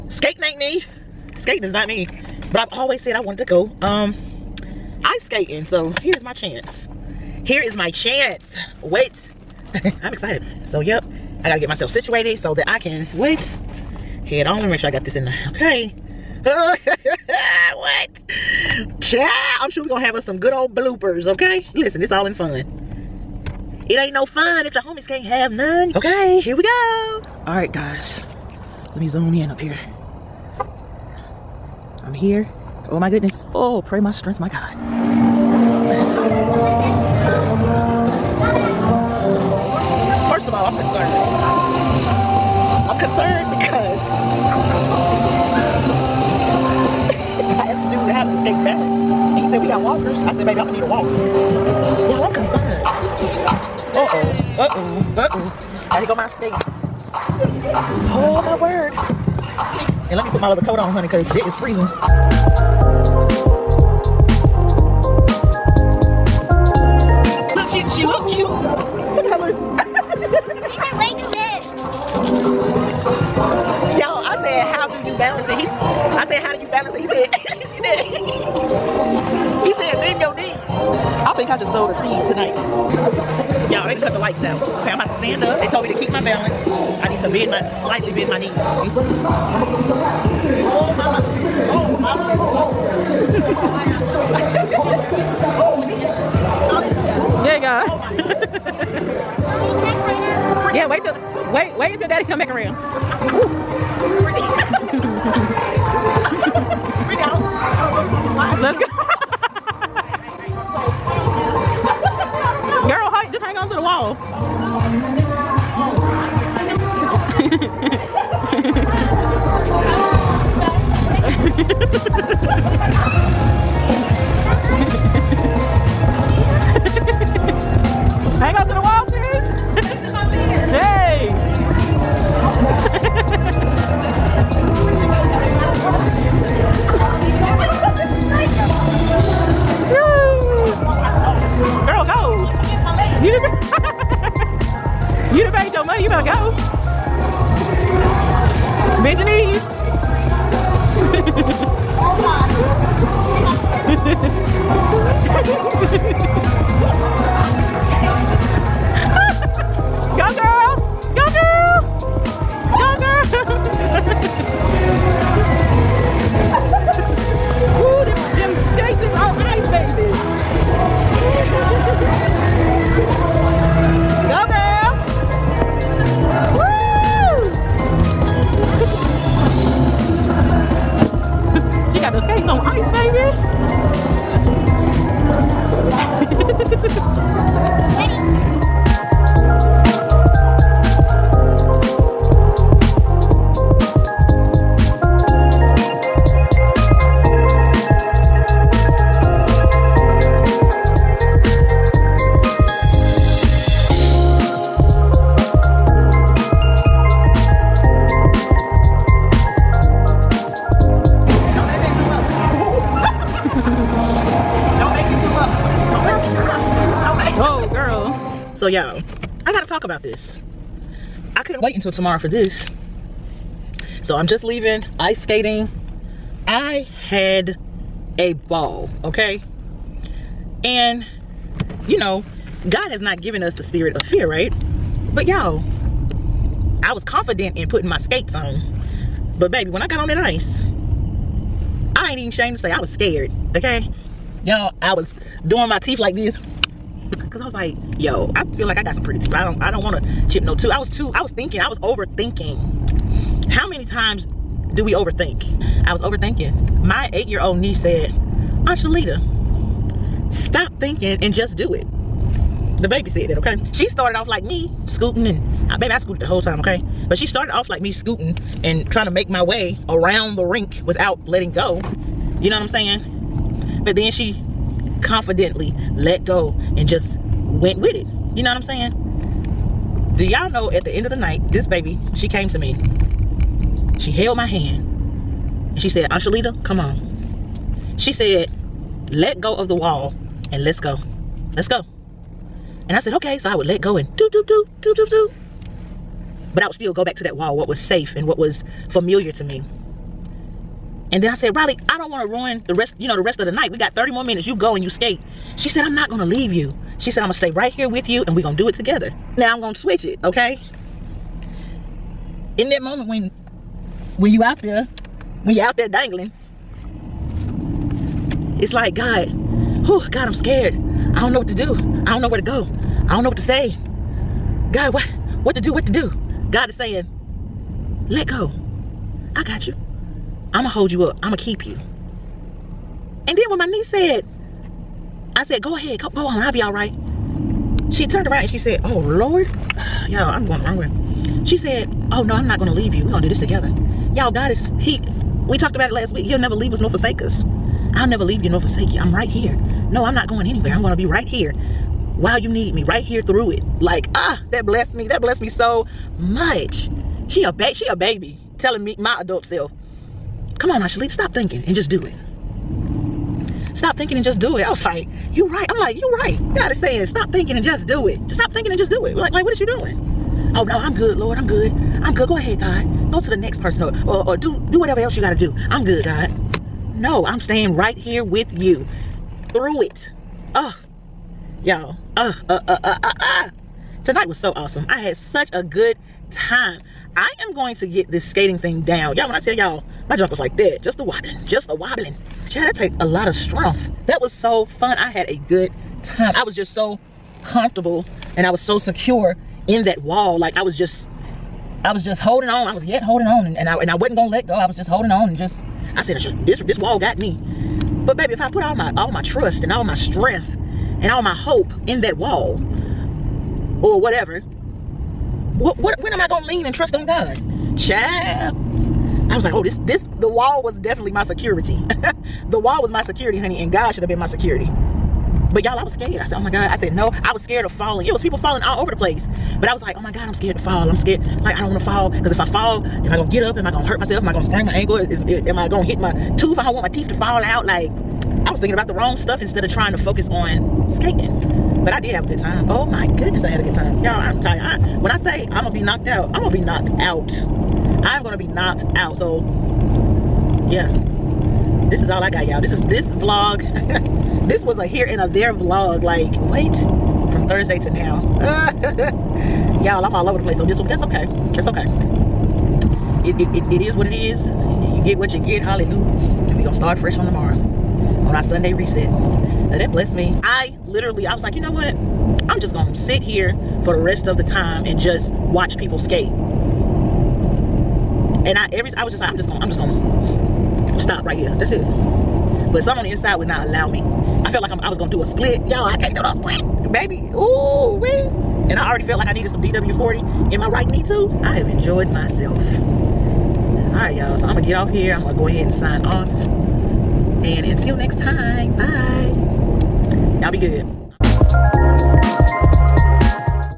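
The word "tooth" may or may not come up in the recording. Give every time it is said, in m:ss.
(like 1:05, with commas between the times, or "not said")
4:10, 7:16.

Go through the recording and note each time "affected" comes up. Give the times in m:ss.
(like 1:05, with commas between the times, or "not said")
not said.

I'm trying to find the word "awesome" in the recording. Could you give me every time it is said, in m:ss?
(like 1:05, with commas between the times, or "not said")
6:24.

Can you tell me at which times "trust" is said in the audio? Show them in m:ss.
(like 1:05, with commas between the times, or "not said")
6:49, 6:56.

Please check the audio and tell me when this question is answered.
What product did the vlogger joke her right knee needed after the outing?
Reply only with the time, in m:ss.
8:09.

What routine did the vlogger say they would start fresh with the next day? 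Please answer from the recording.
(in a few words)
Sunday reset.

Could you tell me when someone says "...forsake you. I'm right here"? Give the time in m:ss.
5:48.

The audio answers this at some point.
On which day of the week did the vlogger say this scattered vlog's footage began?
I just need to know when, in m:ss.
7:37.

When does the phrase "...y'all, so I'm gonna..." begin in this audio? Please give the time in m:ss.
8:14.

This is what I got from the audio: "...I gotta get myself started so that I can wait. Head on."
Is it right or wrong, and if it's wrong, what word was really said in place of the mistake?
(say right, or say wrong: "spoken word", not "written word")
wrong: "situated", not "started".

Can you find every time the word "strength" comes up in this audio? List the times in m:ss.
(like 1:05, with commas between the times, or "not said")
0:34, 6:33, 6:49.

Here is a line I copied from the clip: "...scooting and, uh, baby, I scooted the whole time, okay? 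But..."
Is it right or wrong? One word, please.
right.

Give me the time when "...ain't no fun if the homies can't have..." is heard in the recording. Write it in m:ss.
0:23.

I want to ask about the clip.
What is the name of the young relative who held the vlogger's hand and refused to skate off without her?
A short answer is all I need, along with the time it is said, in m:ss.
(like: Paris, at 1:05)
Riley, at 5:01.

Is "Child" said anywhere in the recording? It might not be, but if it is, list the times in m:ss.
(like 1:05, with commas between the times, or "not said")
0:18, 6:57.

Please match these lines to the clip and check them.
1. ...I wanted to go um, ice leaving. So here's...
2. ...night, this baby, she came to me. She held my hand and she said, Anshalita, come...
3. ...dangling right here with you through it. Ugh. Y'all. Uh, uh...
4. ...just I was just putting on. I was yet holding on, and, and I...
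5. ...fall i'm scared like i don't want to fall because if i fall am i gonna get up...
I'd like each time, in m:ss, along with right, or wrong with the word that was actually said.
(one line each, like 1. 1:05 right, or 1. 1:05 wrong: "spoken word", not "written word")
1. 0:03 wrong: "skating", not "leaving"
2. 4:41 right
3. 6:17 wrong: "staying", not "dangling"
4. 6:40 wrong: "holding", not "putting"
5. 7:10 right.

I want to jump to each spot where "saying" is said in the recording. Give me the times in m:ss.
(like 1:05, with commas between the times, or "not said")
4:32, 4:38, 5:26, 6:06.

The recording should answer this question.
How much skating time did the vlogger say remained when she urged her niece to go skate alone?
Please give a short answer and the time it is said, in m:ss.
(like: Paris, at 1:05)
30 minutes, at 5:03.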